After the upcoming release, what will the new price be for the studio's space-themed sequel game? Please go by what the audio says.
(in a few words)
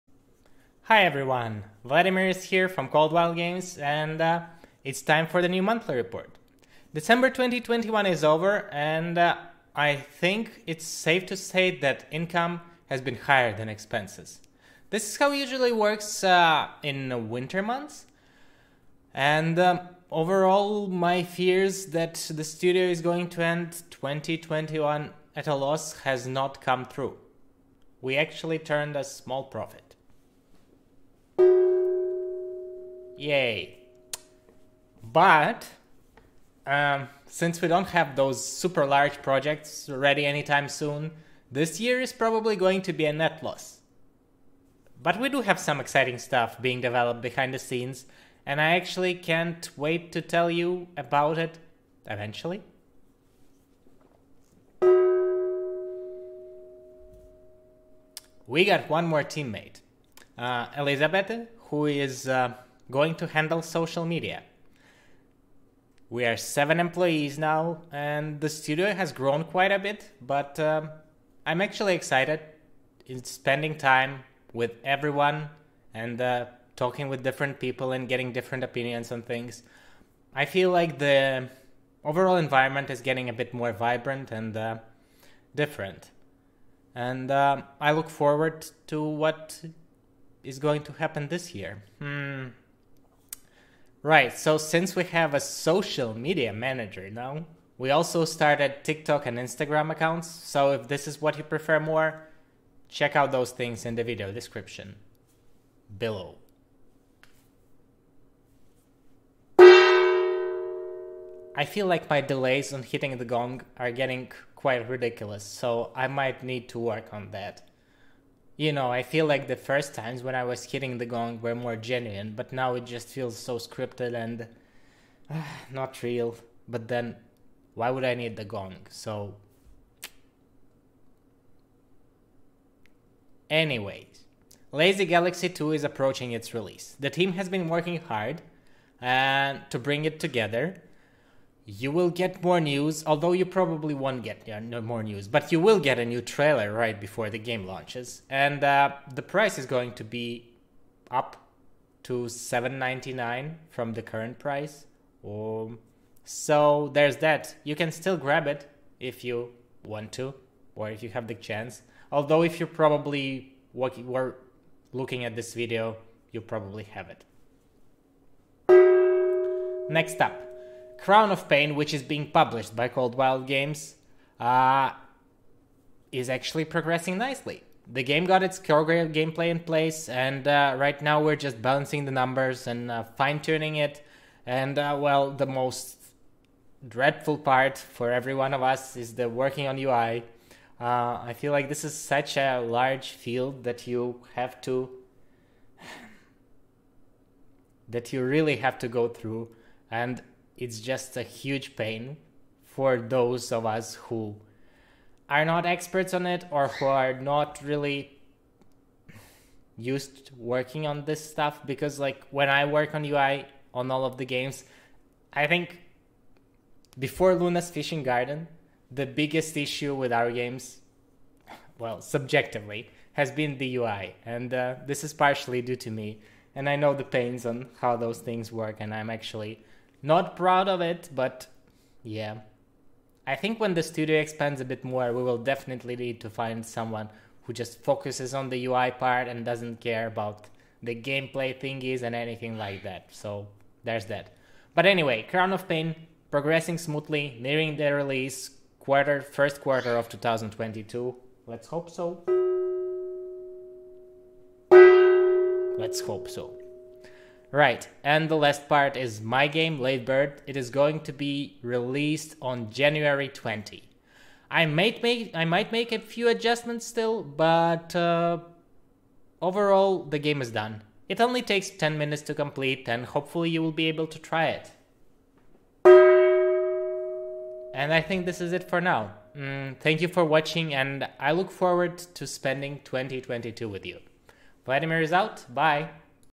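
7.99.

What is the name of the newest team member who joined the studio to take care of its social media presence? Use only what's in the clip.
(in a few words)
Elizabeth.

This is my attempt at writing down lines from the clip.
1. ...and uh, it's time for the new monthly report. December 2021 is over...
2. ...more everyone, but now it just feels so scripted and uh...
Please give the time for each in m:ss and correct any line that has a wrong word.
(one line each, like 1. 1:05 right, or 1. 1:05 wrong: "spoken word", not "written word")
1. 0:03 right
2. 2:01 wrong: "genuine", not "everyone".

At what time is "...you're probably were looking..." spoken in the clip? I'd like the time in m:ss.
2:42.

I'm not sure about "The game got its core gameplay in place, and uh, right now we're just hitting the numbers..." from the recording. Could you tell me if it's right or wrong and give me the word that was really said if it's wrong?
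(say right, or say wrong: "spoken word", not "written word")
wrong: "balancing", not "hitting".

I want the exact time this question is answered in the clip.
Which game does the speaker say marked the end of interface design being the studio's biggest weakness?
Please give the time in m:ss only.
3:37.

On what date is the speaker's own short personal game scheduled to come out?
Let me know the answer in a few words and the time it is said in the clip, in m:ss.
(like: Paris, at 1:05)
January 20, at 4:22.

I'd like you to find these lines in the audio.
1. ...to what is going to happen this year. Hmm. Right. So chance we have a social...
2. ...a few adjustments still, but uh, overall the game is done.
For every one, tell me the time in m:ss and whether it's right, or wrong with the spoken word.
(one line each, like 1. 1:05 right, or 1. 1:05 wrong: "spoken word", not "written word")
1. 1:28 wrong: "since", not "chance"
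2. 4:25 right.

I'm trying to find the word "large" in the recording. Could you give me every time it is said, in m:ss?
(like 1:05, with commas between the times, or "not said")
0:38, 3:12.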